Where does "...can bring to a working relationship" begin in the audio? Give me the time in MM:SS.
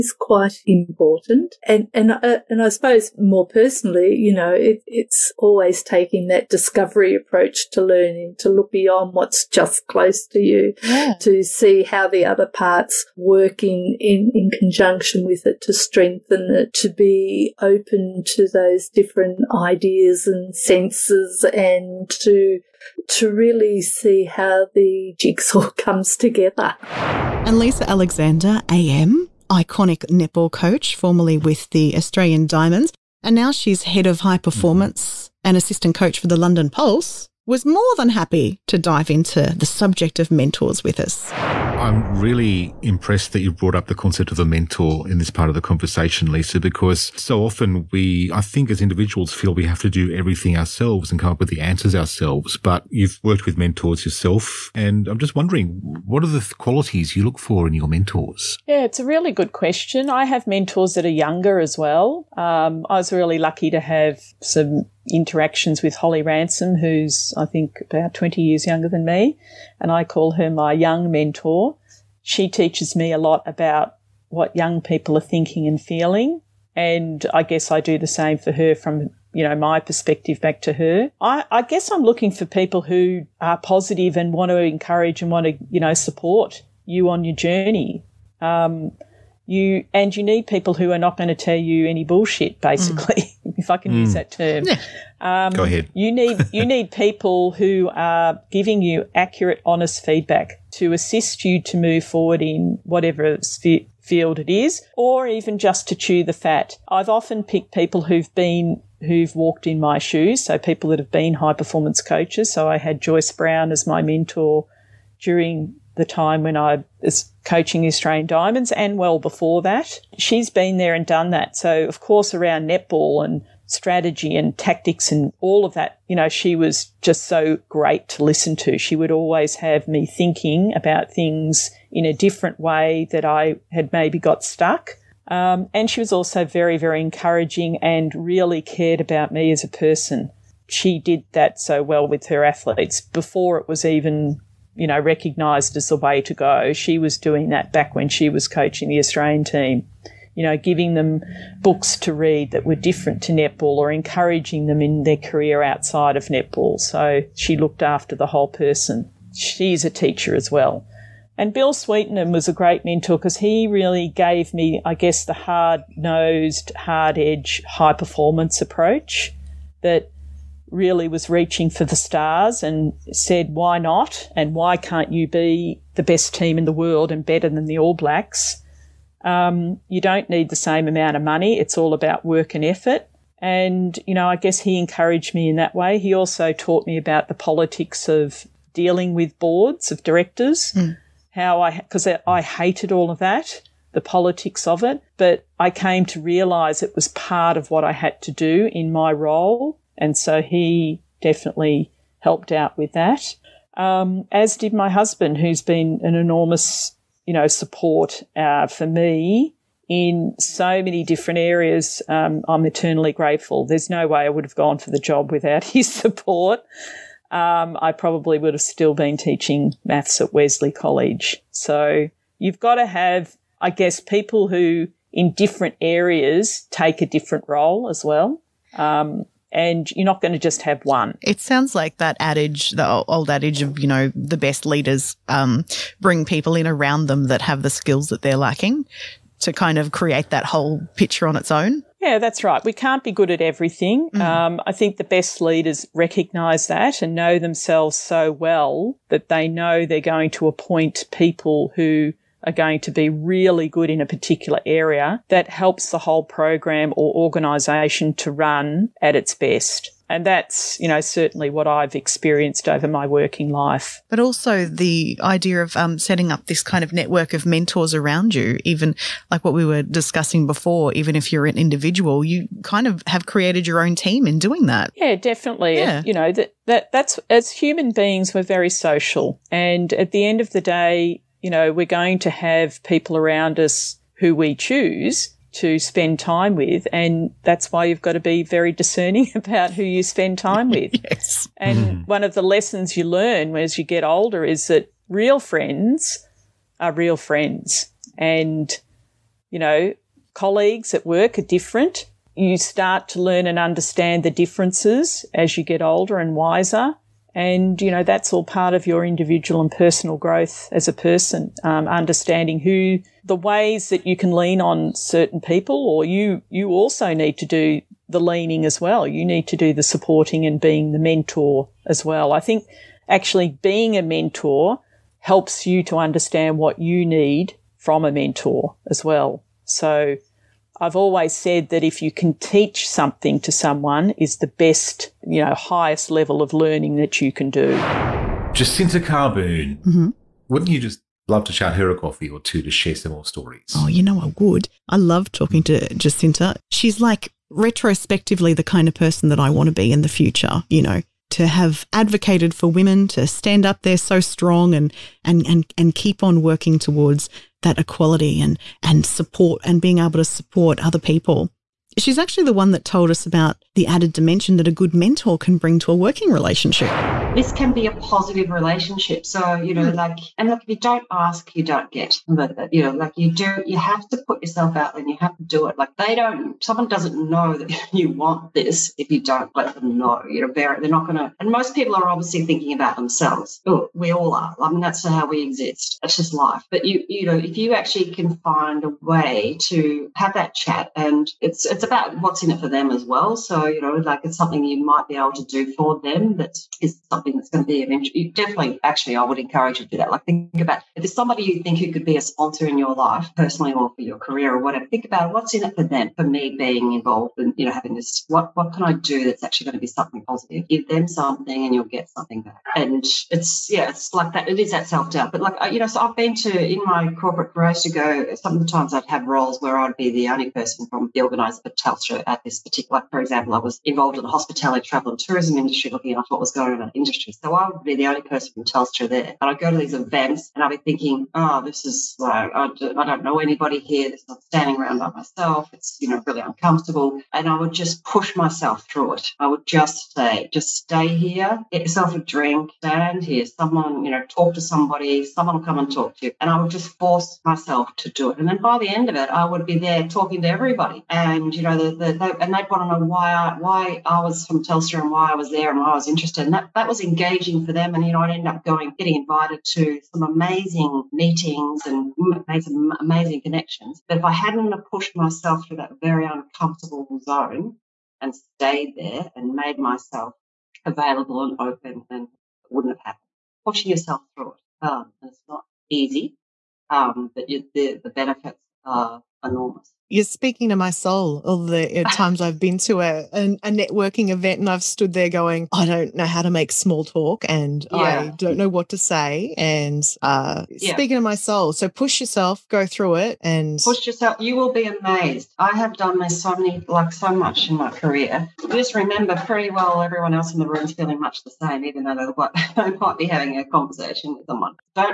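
06:05.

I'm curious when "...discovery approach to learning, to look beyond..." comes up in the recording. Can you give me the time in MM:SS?
00:06.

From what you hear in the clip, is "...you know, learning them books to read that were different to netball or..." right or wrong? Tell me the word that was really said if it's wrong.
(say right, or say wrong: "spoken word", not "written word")
wrong: "giving", not "learning".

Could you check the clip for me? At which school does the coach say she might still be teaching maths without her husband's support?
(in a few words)
Wesley College.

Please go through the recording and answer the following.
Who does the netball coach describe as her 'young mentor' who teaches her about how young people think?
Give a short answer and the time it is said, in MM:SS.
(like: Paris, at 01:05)
Holly Ransom, at 01:05.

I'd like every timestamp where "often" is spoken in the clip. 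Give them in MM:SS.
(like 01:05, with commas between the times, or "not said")
00:47, 01:47.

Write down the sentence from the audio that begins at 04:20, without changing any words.
And that's, you know, certainly what I've experienced over my working life.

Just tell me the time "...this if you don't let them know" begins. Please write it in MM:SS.
06:18.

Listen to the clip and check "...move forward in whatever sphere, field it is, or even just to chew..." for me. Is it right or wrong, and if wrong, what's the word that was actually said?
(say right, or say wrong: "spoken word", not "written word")
right.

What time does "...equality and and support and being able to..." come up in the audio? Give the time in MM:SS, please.
05:57.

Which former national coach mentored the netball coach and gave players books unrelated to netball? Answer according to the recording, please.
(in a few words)
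Joyce Brown.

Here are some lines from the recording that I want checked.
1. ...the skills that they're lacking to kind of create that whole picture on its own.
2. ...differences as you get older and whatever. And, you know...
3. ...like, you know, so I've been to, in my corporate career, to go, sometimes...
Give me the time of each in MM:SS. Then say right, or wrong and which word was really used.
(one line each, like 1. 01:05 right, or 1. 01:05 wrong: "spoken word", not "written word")
1. 03:57 right
2. 05:04 wrong: "wiser", not "whatever"
3. 06:55 right.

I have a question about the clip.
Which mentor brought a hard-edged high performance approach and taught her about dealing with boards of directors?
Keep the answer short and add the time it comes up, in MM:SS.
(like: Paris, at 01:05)
Bill Sweetenham, at 02:41.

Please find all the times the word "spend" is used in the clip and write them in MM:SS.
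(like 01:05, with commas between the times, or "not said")
04:45, 04:50.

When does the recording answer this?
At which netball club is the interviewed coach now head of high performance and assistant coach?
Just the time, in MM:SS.
00:36.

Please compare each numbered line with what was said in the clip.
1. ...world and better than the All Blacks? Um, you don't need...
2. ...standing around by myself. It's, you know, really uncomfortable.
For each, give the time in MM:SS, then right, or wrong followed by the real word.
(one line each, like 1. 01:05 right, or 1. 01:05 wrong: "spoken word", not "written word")
1. 02:56 right
2. 07:14 right.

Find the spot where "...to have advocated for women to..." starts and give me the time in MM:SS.
05:51.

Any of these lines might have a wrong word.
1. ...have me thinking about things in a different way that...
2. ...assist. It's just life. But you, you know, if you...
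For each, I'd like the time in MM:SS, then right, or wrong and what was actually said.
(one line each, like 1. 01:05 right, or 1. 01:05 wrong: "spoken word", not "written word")
1. 02:09 right
2. 06:25 wrong: "exist", not "assist".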